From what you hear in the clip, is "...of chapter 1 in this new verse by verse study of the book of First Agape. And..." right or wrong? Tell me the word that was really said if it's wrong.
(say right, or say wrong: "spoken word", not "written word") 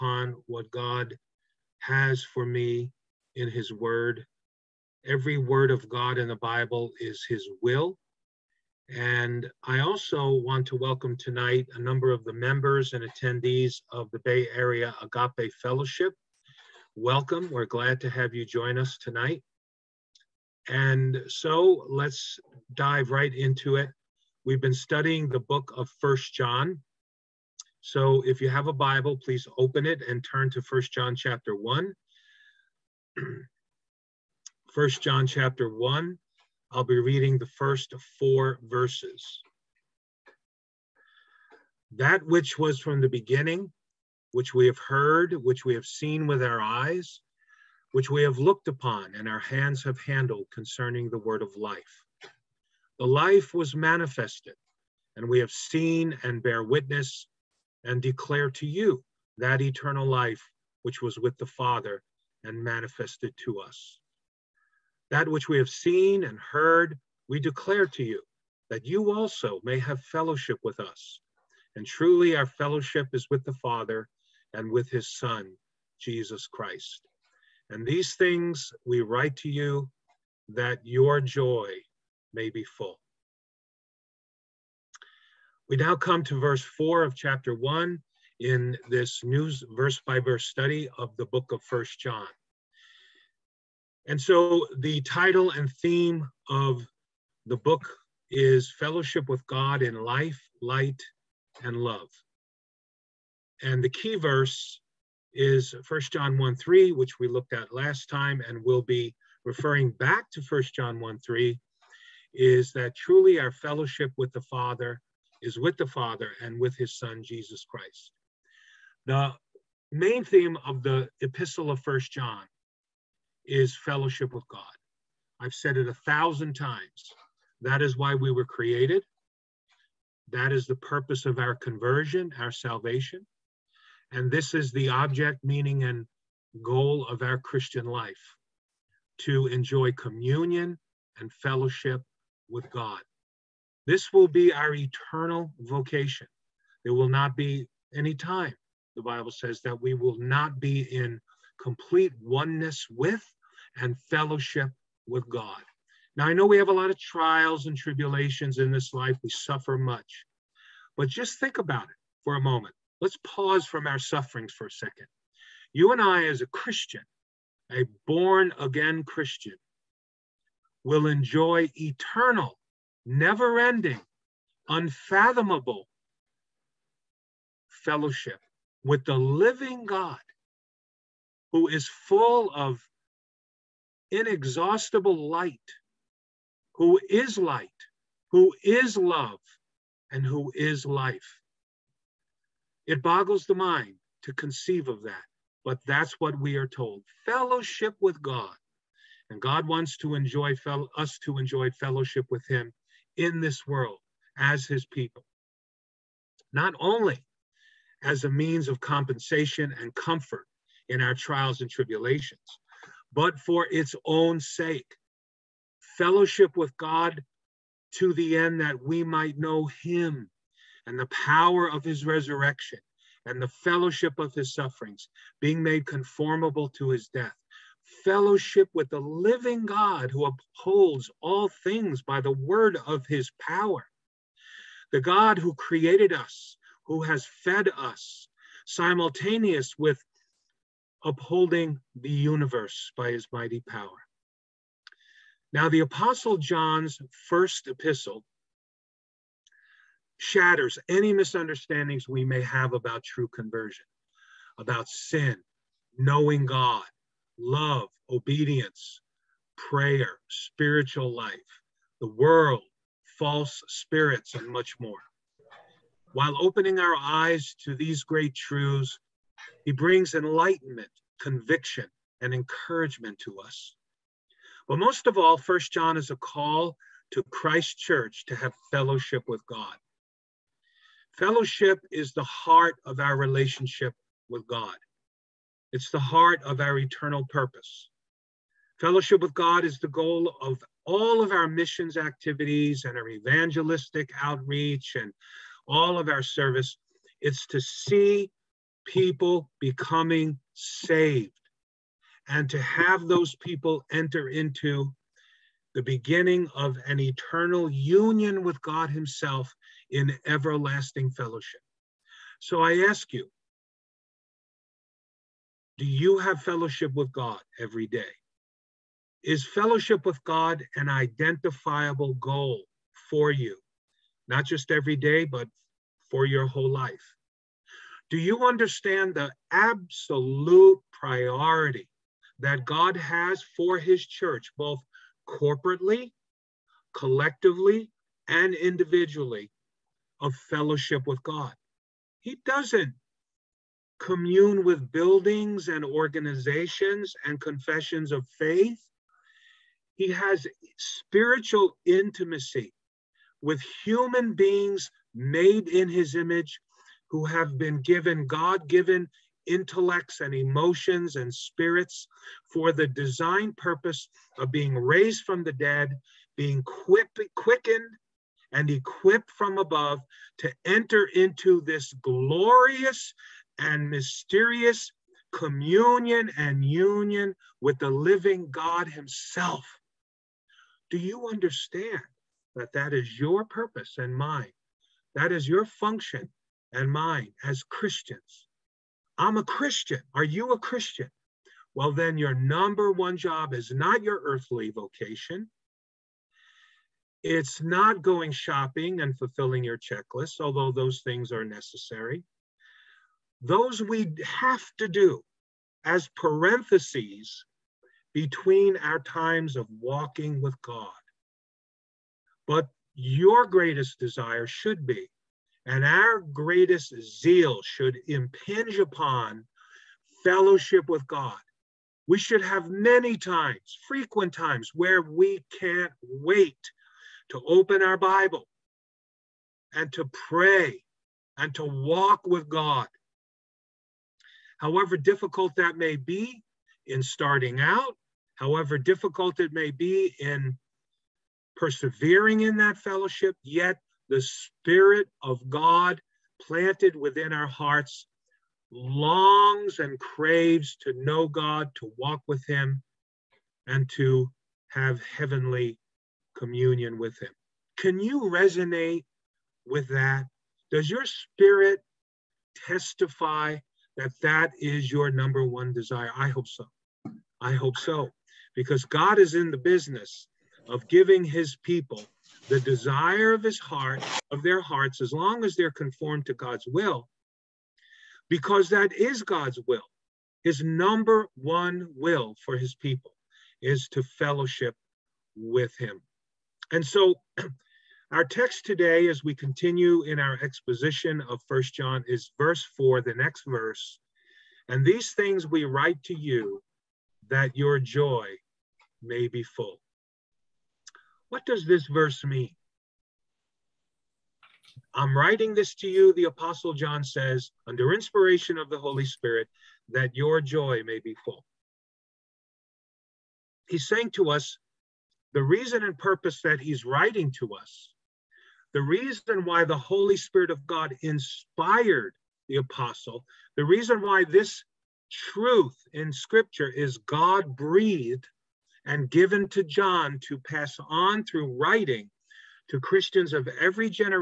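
wrong: "John", not "Agape".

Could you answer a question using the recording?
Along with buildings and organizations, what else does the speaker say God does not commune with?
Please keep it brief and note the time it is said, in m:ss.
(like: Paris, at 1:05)
Confessions of faith, at 5:47.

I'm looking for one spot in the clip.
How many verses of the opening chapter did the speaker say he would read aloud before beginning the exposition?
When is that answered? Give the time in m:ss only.
0:37.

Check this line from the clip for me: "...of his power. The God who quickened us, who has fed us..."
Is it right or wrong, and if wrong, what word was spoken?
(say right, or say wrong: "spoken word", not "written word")
wrong: "created", not "quickened".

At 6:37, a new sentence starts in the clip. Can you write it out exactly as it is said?
It's not going shopping and fulfilling your checklist, although those things are necessary.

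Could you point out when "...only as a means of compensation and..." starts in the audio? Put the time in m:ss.
3:26.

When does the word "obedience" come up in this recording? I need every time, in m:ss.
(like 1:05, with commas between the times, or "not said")
4:18.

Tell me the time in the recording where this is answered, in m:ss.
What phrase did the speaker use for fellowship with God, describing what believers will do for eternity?
2:24.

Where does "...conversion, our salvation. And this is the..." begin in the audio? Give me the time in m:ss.
2:11.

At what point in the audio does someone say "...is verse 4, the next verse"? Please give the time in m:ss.
8:12.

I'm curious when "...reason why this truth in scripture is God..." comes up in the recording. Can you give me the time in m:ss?
8:43.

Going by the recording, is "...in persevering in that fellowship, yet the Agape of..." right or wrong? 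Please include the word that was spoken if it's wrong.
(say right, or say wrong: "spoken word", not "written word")
wrong: "Spirit", not "Agape".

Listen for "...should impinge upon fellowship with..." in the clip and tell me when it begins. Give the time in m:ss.
6:57.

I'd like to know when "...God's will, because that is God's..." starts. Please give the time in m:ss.
7:56.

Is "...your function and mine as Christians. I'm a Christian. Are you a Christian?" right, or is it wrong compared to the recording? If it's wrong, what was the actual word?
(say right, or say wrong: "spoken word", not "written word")
right.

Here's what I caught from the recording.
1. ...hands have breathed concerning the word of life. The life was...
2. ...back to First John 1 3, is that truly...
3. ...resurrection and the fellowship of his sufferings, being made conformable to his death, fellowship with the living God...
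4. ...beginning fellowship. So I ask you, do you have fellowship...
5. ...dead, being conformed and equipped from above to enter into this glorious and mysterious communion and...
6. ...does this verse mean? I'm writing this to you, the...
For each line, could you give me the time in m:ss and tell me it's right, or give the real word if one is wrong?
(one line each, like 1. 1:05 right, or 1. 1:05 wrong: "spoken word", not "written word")
1. 0:49 wrong: "handled", not "breathed"
2. 1:49 right
3. 3:42 right
4. 5:10 wrong: "everlasting", not "beginning"
5. 6:05 wrong: "quickened", not "conformed"
6. 8:21 right.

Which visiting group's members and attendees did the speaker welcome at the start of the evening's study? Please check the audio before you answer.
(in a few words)
Bay Area Agape Fellowship.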